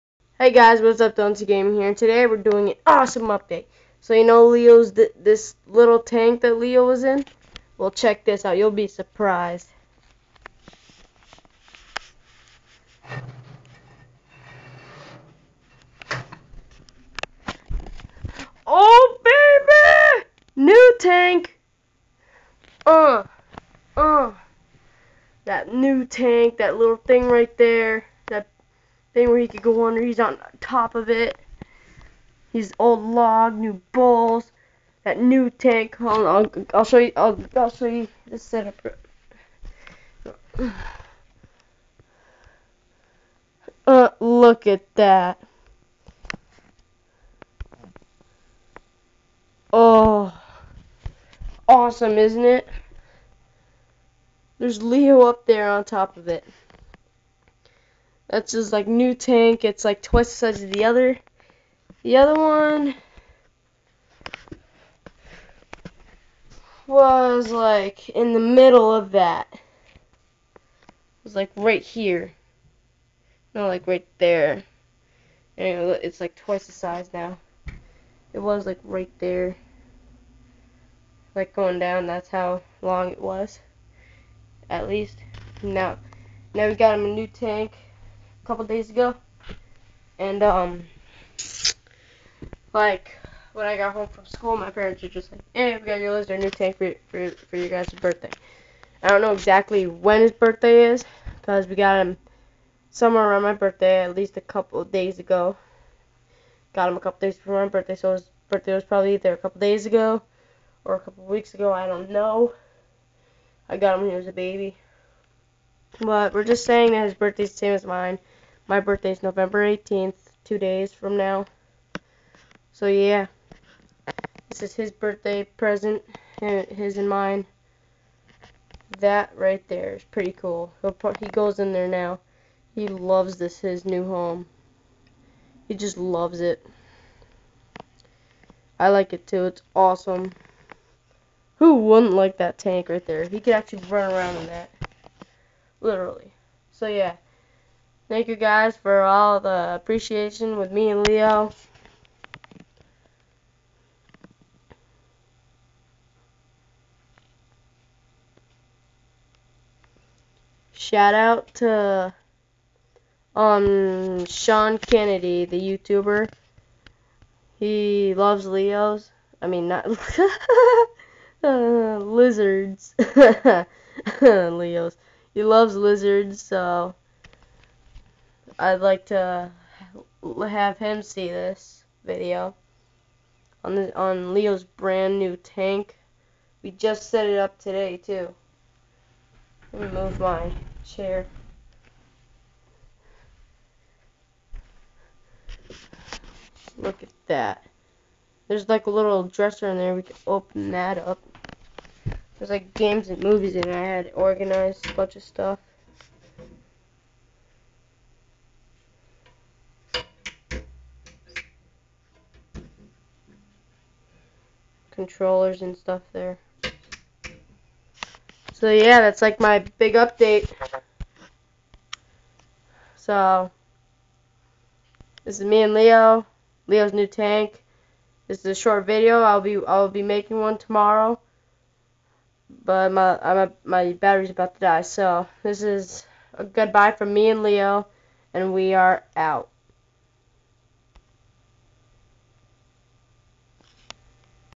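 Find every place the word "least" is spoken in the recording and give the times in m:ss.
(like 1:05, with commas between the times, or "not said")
1:24, 1:44.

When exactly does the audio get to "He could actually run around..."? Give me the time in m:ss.
2:23.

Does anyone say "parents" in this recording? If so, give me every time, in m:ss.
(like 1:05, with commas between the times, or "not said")
1:34.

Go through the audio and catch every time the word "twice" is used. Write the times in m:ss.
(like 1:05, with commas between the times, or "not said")
1:00, 1:16.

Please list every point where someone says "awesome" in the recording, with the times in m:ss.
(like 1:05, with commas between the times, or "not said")
0:02, 0:51, 2:19.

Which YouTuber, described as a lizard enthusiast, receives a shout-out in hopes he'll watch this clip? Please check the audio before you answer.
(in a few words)
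Sean Kennedy.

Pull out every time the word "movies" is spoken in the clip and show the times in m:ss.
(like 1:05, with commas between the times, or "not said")
3:23.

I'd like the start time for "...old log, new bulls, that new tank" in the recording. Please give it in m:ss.
0:32.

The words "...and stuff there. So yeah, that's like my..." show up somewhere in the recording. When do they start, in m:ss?
3:35.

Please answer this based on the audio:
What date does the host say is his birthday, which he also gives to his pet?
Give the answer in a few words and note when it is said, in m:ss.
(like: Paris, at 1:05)
November 18th, at 1:59.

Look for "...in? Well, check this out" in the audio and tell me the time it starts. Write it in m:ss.
0:07.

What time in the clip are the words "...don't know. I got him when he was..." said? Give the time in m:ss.
1:51.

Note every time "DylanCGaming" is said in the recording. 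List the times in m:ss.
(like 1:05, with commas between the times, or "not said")
0:01.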